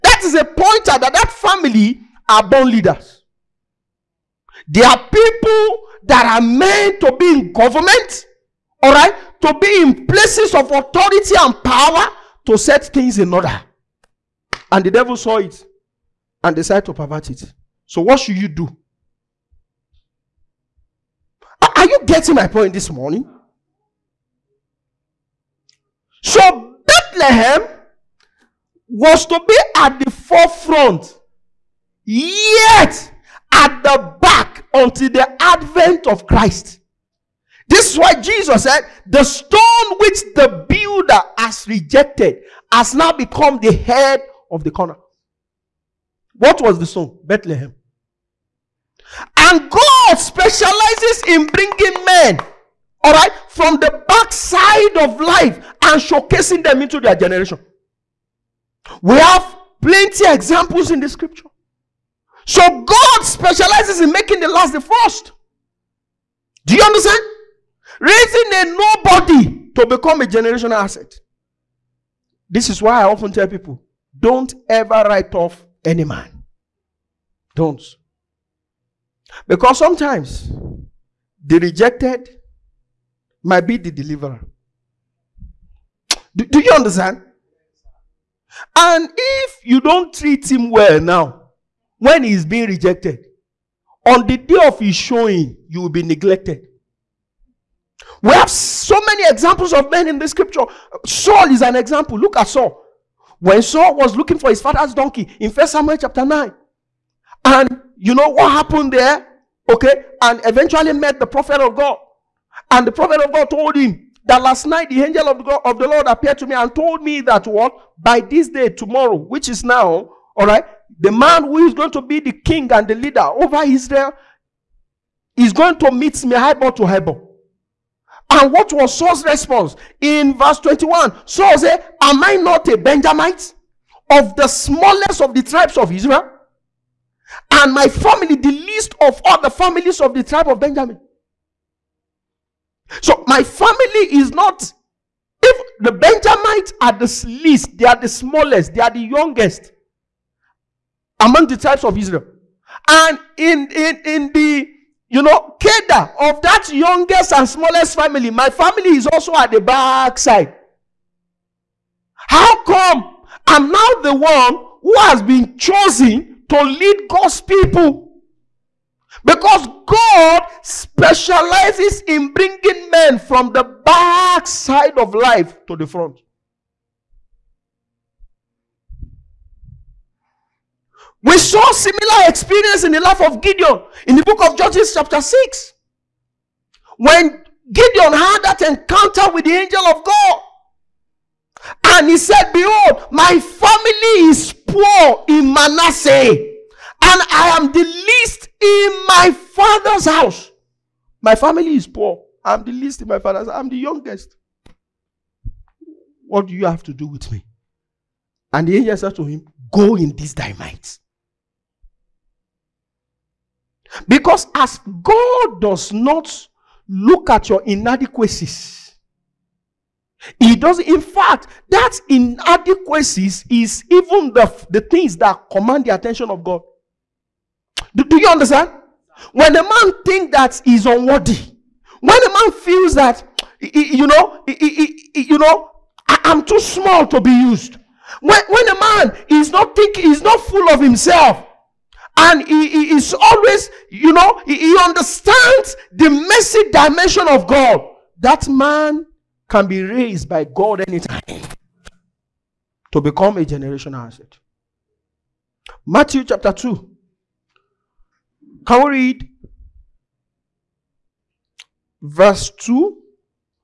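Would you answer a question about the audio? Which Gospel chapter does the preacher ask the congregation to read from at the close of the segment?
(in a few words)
Matthew chapter 2.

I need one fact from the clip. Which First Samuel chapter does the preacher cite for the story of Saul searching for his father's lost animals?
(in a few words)
Chapter 9.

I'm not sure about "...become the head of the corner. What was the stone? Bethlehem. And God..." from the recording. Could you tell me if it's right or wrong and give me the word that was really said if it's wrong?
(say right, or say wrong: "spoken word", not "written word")
right.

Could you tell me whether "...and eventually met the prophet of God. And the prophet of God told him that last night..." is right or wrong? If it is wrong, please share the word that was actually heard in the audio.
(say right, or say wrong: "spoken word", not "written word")
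right.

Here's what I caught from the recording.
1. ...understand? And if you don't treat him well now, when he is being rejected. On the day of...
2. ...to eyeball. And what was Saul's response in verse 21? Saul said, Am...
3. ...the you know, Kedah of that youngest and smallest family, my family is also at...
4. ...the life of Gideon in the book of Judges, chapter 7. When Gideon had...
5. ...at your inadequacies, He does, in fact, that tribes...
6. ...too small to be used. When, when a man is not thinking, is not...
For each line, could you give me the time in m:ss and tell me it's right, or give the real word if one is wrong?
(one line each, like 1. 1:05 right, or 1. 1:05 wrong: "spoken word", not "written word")
1. 1:26 right
2. 2:06 right
3. 2:34 right
4. 3:02 wrong: "6", not "7"
5. 3:37 wrong: "inadequacies", not "tribes"
6. 3:56 right.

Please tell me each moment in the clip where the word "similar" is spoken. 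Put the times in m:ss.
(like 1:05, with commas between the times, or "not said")
3:01.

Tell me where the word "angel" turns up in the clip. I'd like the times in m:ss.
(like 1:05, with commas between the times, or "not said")
1:55, 3:09, 3:28.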